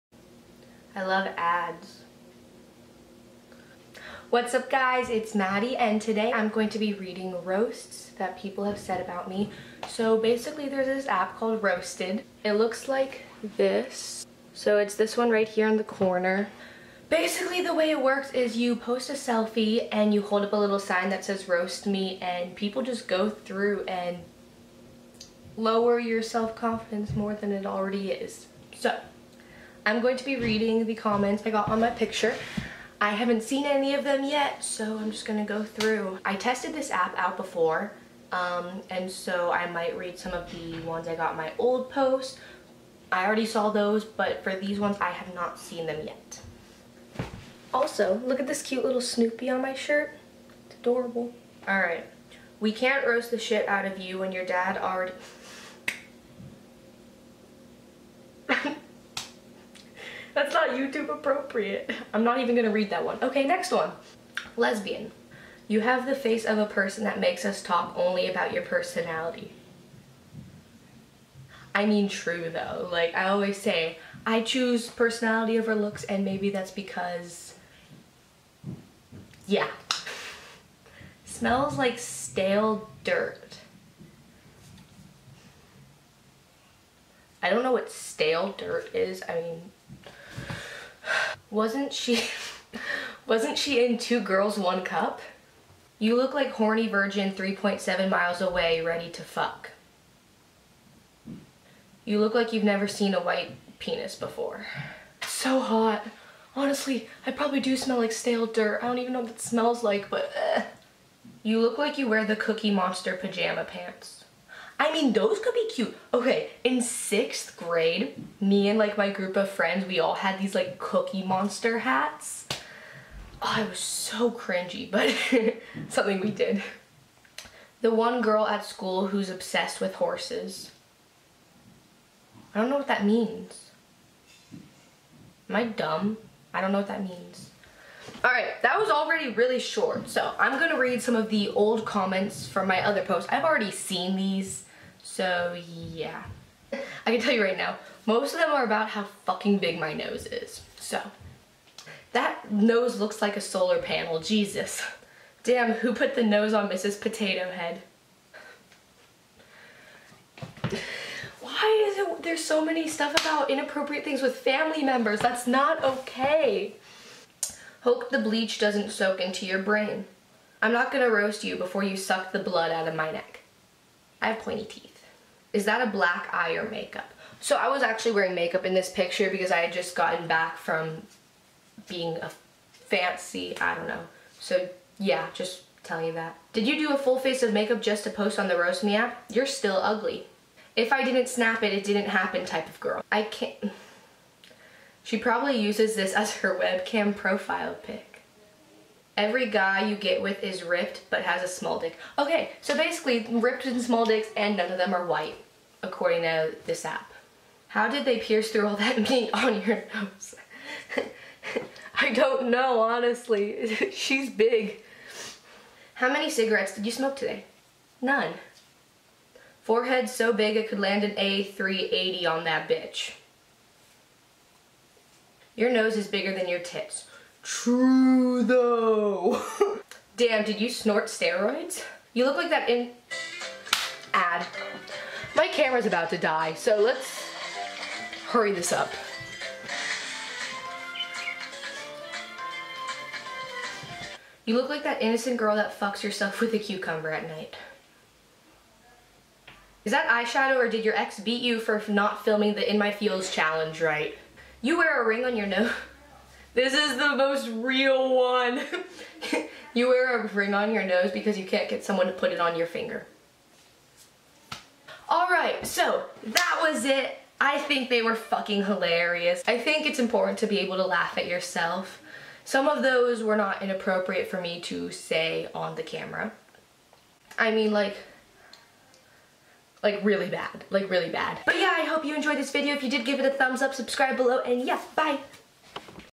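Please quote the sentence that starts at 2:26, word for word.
I can tell you right now, most of them are about how fucking big my nose is.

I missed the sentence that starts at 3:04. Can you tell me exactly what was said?
So yeah, just tell you that.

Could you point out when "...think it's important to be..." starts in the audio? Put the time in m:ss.
4:29.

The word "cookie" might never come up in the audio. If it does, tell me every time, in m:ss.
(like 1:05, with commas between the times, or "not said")
1:52, 2:00.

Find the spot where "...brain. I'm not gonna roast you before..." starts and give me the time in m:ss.
2:49.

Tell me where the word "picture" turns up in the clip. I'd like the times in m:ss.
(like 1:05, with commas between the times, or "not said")
0:31, 2:58.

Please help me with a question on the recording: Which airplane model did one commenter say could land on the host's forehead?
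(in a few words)
A380.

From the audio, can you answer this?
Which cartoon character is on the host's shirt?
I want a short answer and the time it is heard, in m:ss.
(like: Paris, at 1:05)
Snoopy, at 0:49.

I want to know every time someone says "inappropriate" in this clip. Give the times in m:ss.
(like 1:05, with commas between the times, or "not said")
2:43, 4:33.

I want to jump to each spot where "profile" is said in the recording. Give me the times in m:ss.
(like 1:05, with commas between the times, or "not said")
3:17.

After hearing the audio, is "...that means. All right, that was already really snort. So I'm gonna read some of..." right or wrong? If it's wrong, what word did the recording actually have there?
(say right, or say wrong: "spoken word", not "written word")
wrong: "short", not "snort".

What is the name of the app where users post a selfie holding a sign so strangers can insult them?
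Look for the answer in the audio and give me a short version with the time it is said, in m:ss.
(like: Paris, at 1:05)
Roasted, at 0:11.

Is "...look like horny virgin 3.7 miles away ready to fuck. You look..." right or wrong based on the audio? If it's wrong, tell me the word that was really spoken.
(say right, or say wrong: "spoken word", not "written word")
right.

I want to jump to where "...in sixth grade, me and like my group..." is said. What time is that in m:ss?
1:56.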